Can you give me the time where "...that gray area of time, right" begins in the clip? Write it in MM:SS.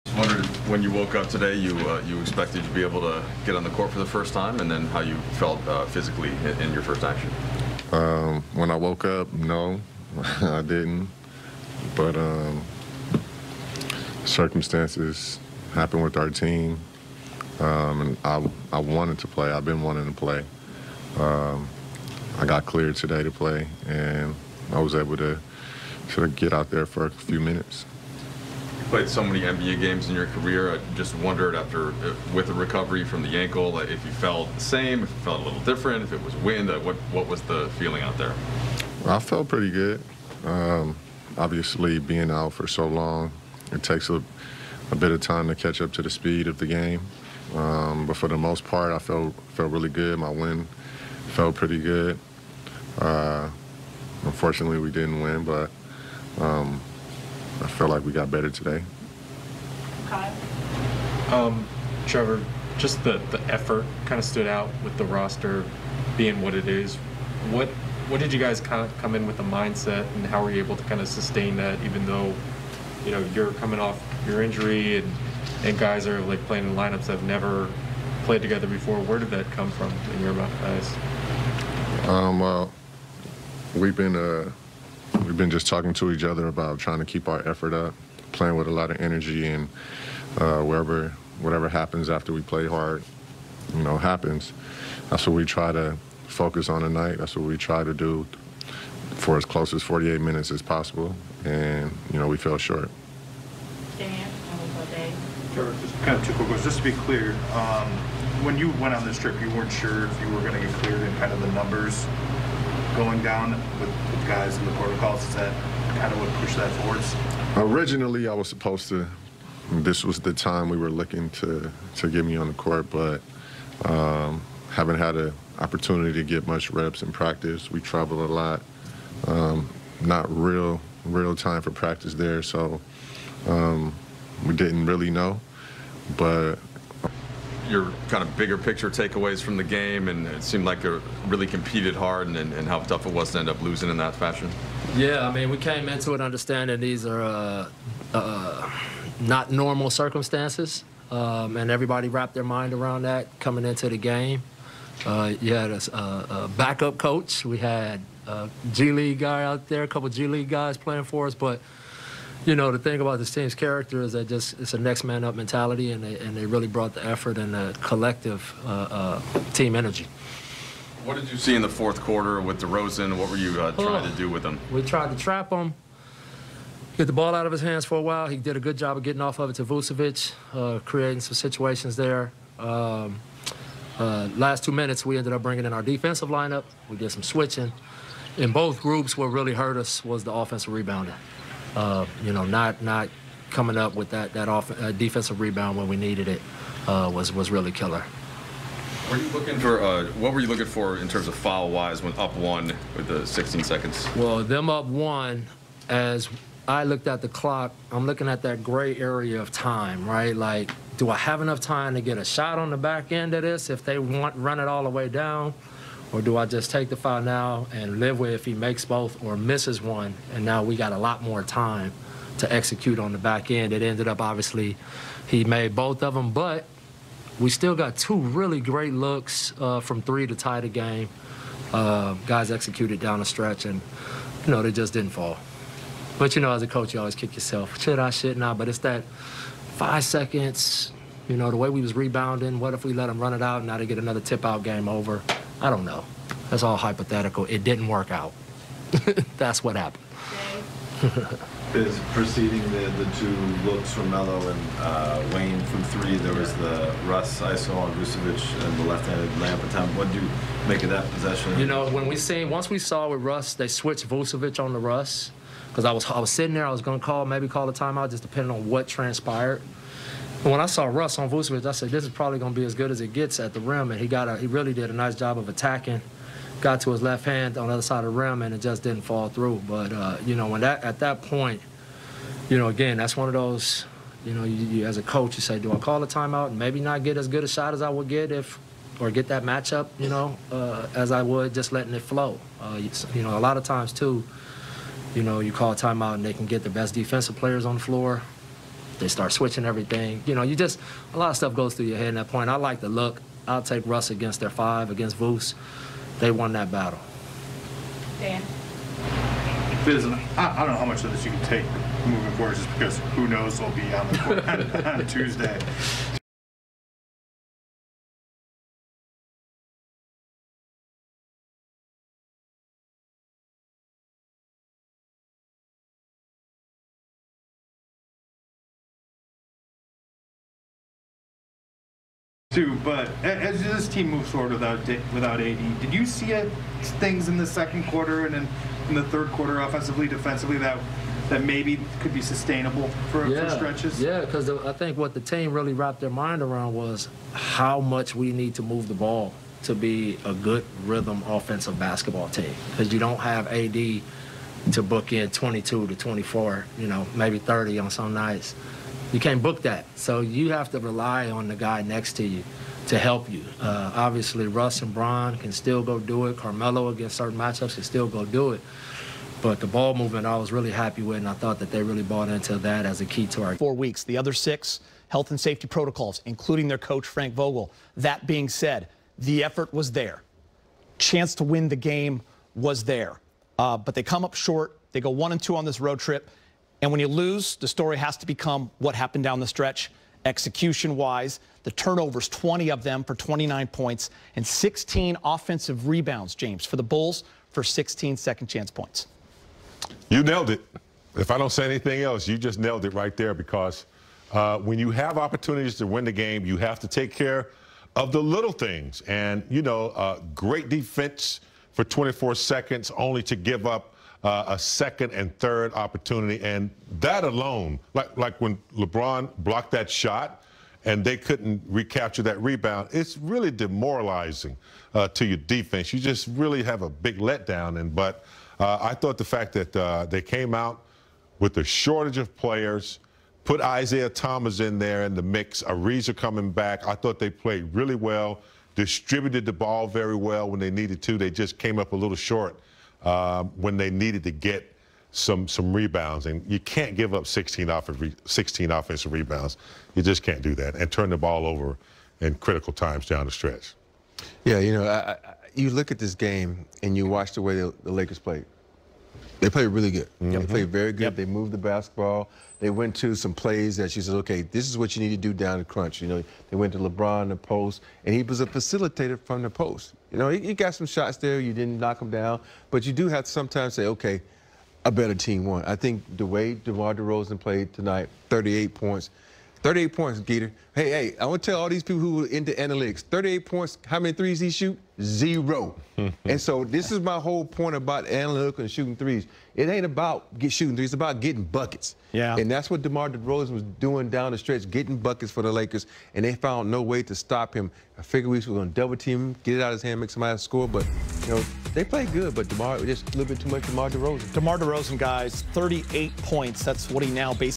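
03:28.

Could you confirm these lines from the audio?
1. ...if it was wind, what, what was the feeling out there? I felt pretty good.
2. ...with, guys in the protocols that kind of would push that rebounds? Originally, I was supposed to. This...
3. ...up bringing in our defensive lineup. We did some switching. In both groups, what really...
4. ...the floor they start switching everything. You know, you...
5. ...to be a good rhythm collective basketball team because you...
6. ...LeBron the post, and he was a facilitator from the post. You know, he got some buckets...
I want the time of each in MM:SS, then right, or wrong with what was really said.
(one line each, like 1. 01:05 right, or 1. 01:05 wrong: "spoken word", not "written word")
1. 00:36 right
2. 01:53 wrong: "forwards", not "rebounds"
3. 03:05 right
4. 04:57 right
5. 05:49 wrong: "offensive", not "collective"
6. 07:46 wrong: "shots", not "buckets".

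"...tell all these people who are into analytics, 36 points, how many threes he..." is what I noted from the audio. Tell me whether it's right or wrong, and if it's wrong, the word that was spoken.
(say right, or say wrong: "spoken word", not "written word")
wrong: "38", not "36".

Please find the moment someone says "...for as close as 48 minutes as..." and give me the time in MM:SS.
01:39.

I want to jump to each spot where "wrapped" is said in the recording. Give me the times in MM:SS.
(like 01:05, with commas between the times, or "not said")
02:32, 05:45.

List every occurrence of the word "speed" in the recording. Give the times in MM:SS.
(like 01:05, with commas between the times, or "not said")
00:46.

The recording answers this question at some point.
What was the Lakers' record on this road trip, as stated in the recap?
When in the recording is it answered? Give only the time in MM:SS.
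06:25.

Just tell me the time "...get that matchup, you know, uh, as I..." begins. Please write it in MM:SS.
04:49.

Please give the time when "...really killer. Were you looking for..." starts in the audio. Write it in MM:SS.
03:17.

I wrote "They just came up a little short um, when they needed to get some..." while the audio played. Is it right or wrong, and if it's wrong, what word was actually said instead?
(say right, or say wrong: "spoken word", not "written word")
right.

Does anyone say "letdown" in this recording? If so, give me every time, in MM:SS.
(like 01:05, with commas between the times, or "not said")
07:07.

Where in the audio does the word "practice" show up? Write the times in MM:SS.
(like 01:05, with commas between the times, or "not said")
02:07, 02:11.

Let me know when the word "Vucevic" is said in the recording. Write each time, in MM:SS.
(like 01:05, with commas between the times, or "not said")
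02:59, 04:17, 04:24, 04:31.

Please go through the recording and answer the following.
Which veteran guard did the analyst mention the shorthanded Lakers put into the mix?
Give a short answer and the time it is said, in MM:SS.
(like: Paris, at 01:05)
Isaiah Thomas, at 07:13.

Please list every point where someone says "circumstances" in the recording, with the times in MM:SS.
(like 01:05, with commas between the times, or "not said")
00:14, 02:29.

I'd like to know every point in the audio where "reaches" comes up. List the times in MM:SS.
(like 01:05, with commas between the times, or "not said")
not said.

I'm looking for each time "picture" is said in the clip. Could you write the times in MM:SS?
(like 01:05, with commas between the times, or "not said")
02:18.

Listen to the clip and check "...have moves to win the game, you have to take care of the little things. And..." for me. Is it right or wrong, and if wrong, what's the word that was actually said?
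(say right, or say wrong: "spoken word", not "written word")
wrong: "opportunities", not "moves".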